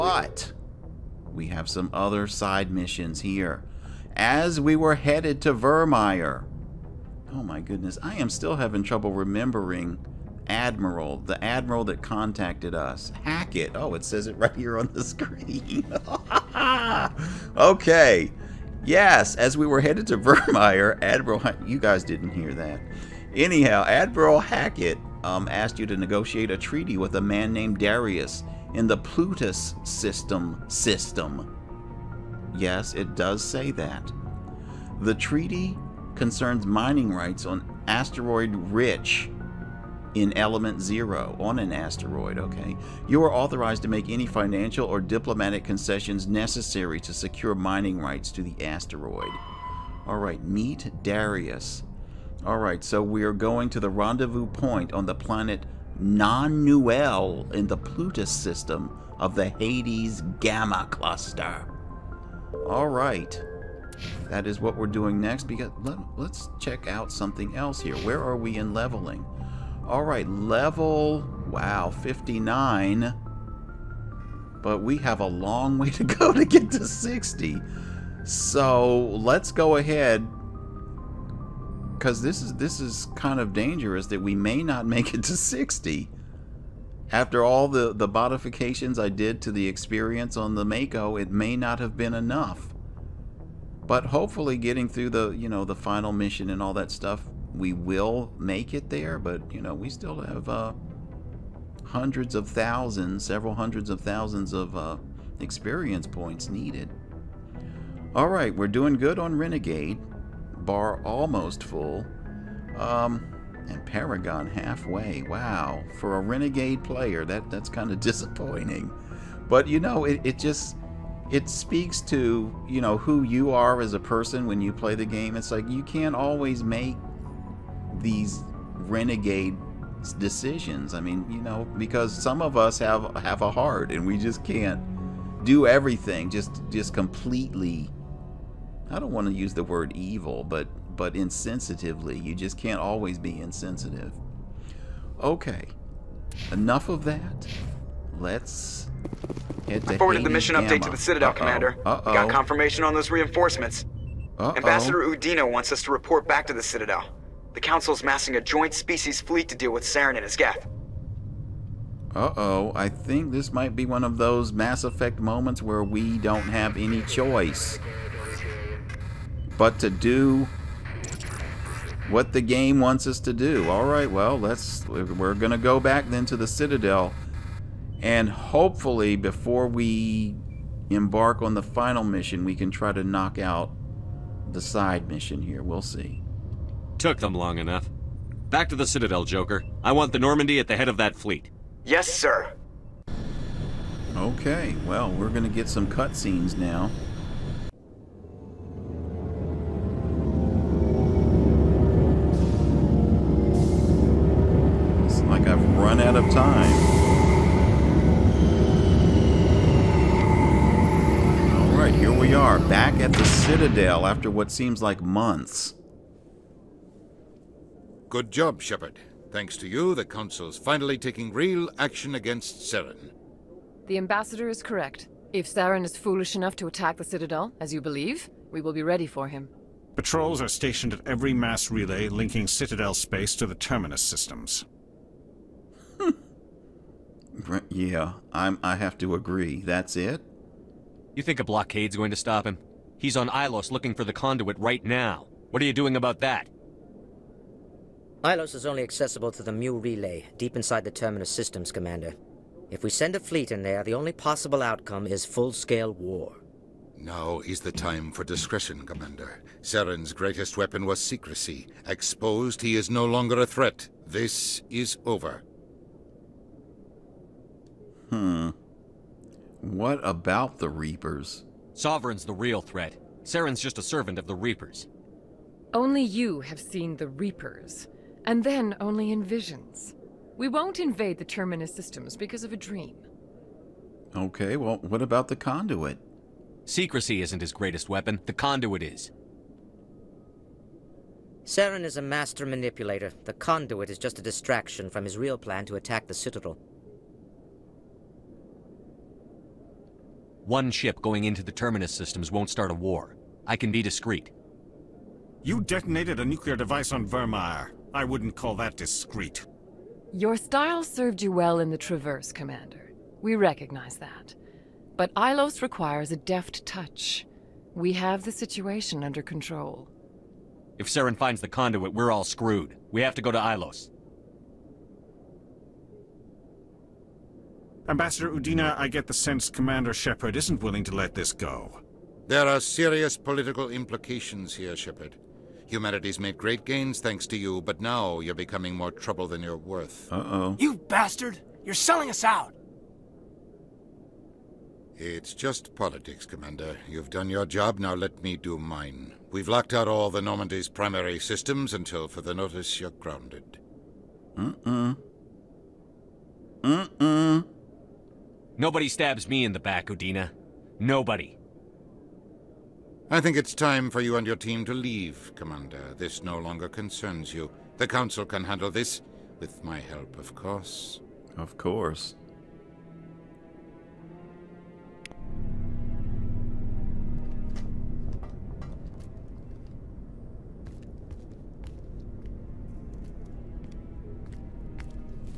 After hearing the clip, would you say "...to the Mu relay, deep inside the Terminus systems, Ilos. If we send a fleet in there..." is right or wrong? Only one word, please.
wrong.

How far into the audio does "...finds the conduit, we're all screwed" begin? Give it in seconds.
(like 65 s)
321 s.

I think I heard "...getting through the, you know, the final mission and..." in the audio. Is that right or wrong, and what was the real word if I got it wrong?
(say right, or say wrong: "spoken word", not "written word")
right.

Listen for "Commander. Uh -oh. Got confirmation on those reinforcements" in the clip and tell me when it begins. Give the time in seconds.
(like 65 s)
151 s.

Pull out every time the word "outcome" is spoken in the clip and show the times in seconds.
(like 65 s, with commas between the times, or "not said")
254 s.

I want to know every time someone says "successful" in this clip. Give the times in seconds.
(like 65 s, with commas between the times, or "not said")
not said.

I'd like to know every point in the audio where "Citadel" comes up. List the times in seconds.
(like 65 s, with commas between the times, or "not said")
150 s, 156 s, 176 s, 188 s, 213 s, 227 s, 232 s, 296 s.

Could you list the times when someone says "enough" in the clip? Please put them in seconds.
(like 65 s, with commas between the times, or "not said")
92 s, 146 s, 187 s, 226 s.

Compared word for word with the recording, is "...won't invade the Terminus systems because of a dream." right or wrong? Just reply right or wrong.
right.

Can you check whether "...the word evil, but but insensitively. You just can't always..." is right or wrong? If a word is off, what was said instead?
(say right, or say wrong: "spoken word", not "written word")
right.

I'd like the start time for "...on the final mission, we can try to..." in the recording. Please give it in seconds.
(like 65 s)
181 s.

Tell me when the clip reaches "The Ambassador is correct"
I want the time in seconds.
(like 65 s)
223 s.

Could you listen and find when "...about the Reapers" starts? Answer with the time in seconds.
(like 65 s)
270 s.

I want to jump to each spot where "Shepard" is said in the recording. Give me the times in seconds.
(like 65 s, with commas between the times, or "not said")
218 s, 329 s, 334 s.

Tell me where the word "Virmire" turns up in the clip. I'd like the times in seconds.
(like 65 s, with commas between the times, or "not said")
5 s, 20 s, 307 s.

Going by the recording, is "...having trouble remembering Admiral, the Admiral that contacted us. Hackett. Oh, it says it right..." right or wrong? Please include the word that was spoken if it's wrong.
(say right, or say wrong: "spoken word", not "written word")
right.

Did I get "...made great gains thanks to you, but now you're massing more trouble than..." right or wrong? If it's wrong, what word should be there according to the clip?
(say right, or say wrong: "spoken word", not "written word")
wrong: "becoming", not "massing".